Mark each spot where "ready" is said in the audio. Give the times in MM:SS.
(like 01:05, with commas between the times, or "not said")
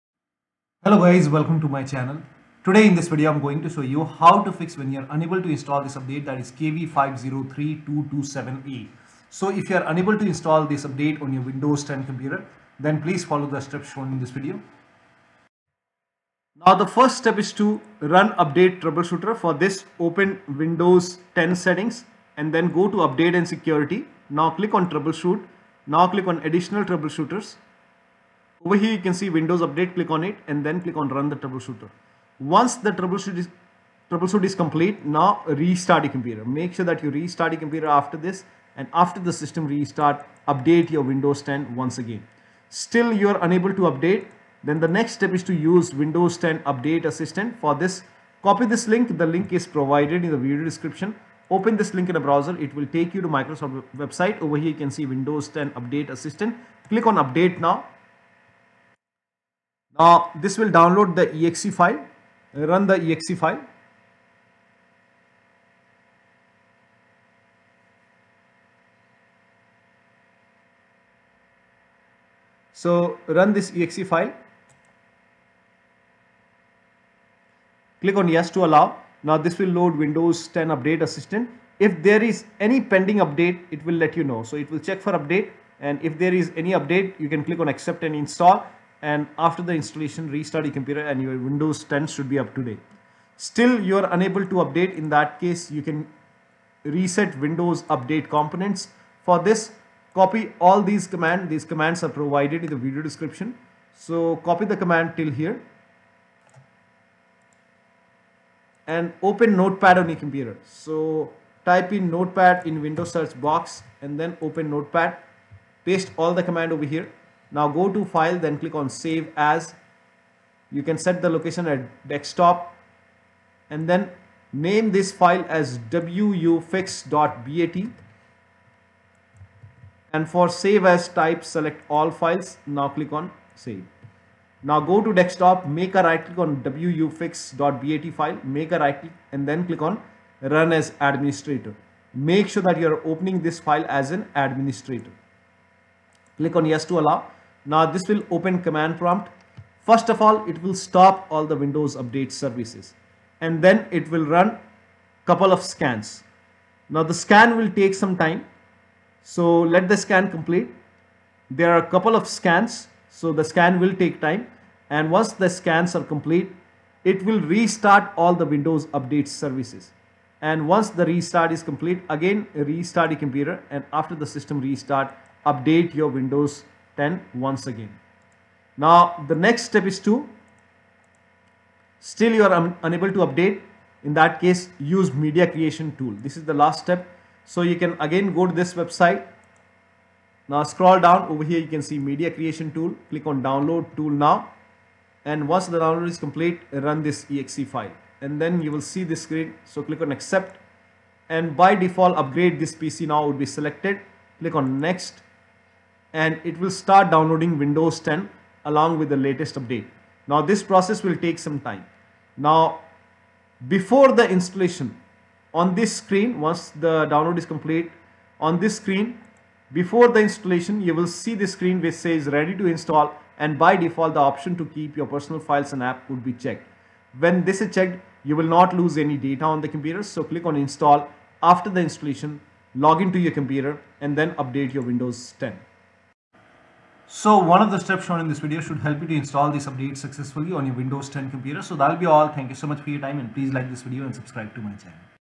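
03:42.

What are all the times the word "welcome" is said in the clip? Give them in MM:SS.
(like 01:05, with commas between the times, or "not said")
00:01.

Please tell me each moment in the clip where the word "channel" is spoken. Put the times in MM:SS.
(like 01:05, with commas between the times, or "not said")
00:01, 04:04.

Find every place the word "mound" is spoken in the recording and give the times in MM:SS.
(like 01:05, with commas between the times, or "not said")
not said.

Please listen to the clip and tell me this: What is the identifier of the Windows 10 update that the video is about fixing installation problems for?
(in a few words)
KB5032278.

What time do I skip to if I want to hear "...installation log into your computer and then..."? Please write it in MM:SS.
03:51.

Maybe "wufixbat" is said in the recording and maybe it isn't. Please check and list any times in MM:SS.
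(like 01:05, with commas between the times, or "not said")
02:05, 02:16.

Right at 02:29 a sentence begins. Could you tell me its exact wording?
First of all, it will stop all the Windows update services and then it will run couple of scans.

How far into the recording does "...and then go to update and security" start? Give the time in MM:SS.
00:22.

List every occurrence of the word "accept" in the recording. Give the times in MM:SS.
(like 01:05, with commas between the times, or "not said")
01:27, 03:20.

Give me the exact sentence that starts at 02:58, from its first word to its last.
Now the next step is to still you are un unable to update in that case use media creation tool.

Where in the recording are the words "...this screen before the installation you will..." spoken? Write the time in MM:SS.
03:38.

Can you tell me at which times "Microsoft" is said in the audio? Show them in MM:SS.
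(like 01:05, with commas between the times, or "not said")
00:53.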